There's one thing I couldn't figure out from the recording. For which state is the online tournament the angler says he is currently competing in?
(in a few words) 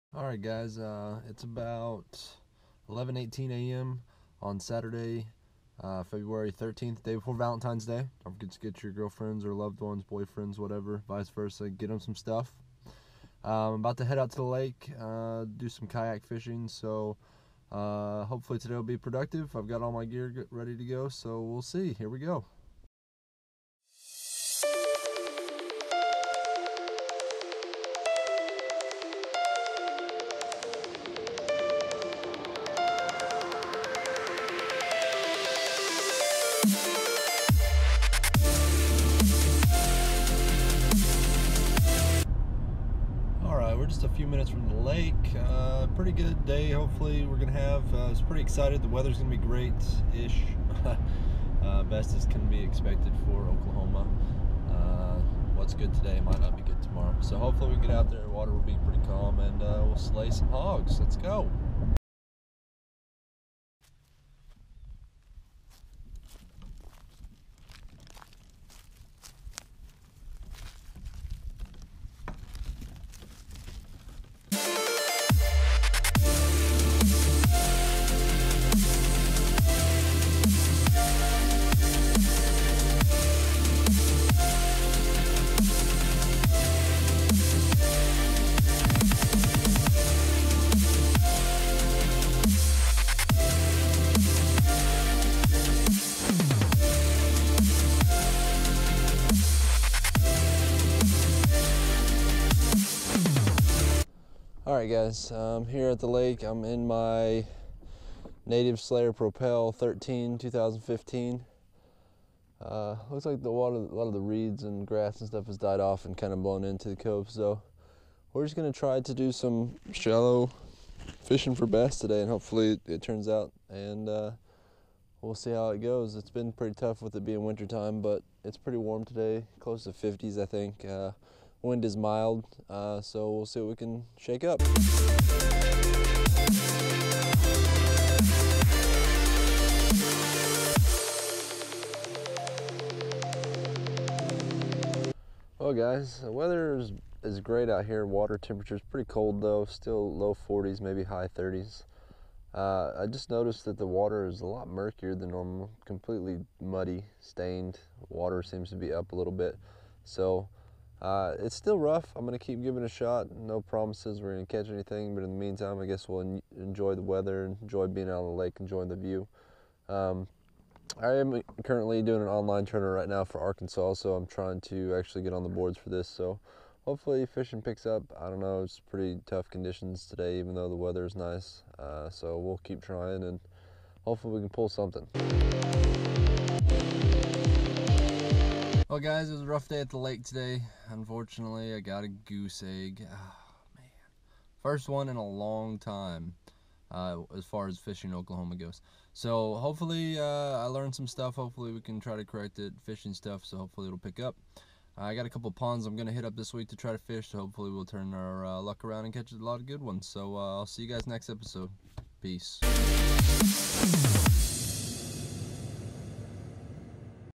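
Arkansas.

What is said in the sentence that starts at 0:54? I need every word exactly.
Uh, what's good today might not be good tomorrow.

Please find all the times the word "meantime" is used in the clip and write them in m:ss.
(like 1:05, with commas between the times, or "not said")
2:45.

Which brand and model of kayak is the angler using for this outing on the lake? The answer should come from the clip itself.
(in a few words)
Native Slayer Propel 13.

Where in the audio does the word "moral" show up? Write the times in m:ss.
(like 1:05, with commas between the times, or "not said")
not said.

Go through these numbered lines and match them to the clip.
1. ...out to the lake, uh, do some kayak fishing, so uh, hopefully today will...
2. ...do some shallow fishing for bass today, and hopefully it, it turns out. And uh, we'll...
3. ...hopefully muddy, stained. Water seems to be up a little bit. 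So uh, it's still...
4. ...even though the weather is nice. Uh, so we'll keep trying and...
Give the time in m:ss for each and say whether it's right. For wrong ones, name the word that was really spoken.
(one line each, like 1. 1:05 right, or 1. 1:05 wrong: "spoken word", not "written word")
1. 0:14 right
2. 1:59 right
3. 2:35 wrong: "completely", not "hopefully"
4. 3:00 right.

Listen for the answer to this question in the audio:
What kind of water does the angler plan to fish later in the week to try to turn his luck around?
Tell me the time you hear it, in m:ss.
3:25.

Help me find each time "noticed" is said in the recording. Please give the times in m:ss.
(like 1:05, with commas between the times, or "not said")
2:33.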